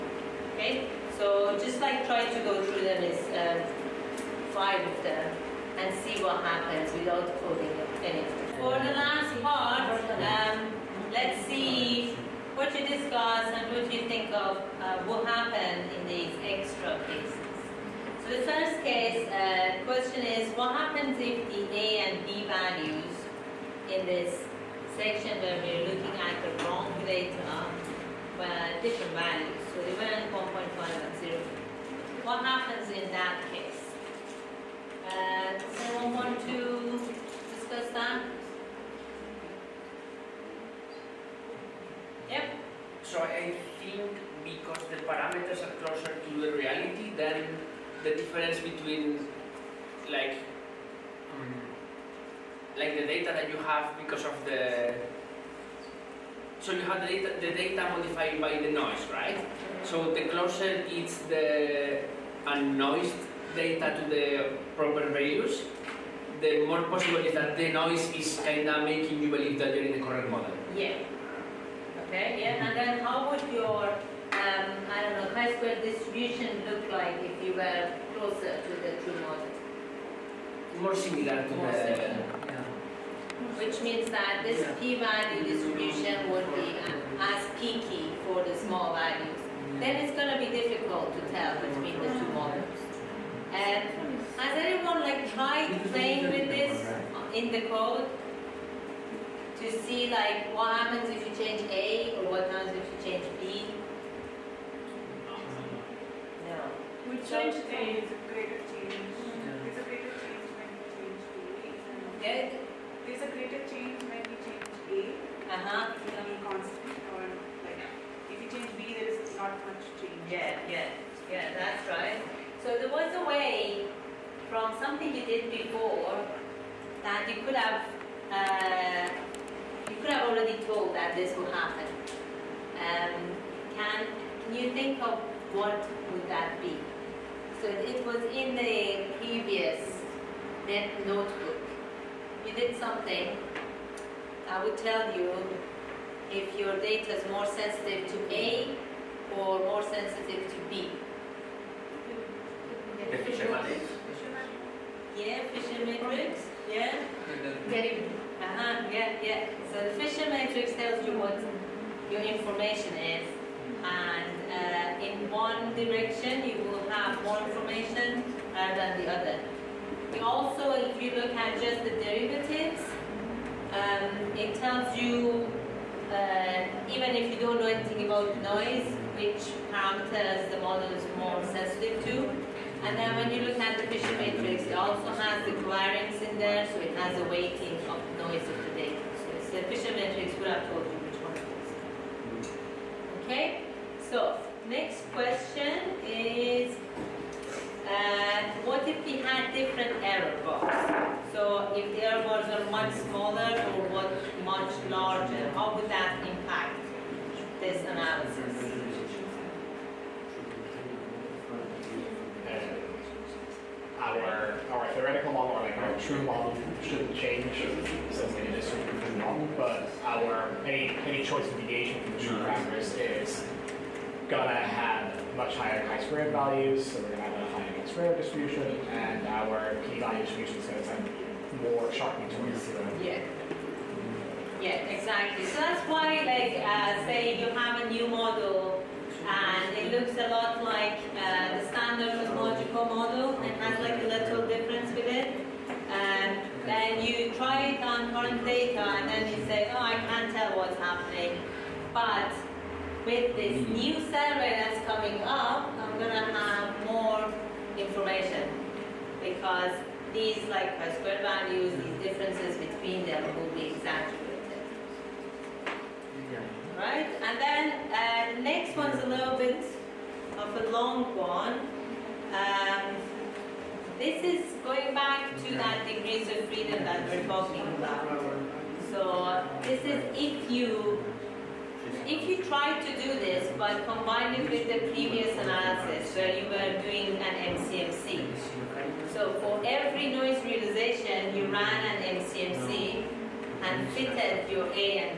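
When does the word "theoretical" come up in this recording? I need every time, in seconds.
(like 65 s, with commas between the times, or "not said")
214 s.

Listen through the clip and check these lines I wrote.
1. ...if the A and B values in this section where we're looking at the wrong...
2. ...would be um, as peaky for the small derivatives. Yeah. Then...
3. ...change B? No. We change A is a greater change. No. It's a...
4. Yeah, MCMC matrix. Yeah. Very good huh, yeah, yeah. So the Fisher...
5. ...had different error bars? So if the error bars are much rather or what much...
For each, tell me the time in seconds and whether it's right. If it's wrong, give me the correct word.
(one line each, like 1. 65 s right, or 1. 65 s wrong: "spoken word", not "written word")
1. 21 s right
2. 86 s wrong: "values", not "derivatives"
3. 103 s right
4. 155 s wrong: "Fisher", not "MCMC"
5. 199 s wrong: "smaller", not "rather".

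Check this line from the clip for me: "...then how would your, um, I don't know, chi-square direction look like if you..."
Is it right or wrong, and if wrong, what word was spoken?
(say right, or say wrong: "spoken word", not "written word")
wrong: "distribution", not "direction".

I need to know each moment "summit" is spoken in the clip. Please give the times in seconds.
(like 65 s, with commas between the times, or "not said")
not said.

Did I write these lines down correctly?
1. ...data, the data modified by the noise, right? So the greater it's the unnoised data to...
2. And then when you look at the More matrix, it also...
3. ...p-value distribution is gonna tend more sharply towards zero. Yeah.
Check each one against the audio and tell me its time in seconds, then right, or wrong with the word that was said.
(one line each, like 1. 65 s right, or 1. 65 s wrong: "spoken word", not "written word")
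1. 57 s wrong: "closer", not "greater"
2. 182 s wrong: "Fisher", not "More"
3. 229 s right.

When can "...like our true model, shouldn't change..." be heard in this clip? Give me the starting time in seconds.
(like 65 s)
215 s.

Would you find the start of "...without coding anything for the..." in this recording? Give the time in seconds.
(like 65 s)
6 s.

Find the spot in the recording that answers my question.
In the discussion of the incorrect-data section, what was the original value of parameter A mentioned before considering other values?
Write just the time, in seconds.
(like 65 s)
30 s.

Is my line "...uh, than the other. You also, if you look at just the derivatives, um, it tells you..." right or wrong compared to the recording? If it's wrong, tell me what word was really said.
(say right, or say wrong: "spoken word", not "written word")
right.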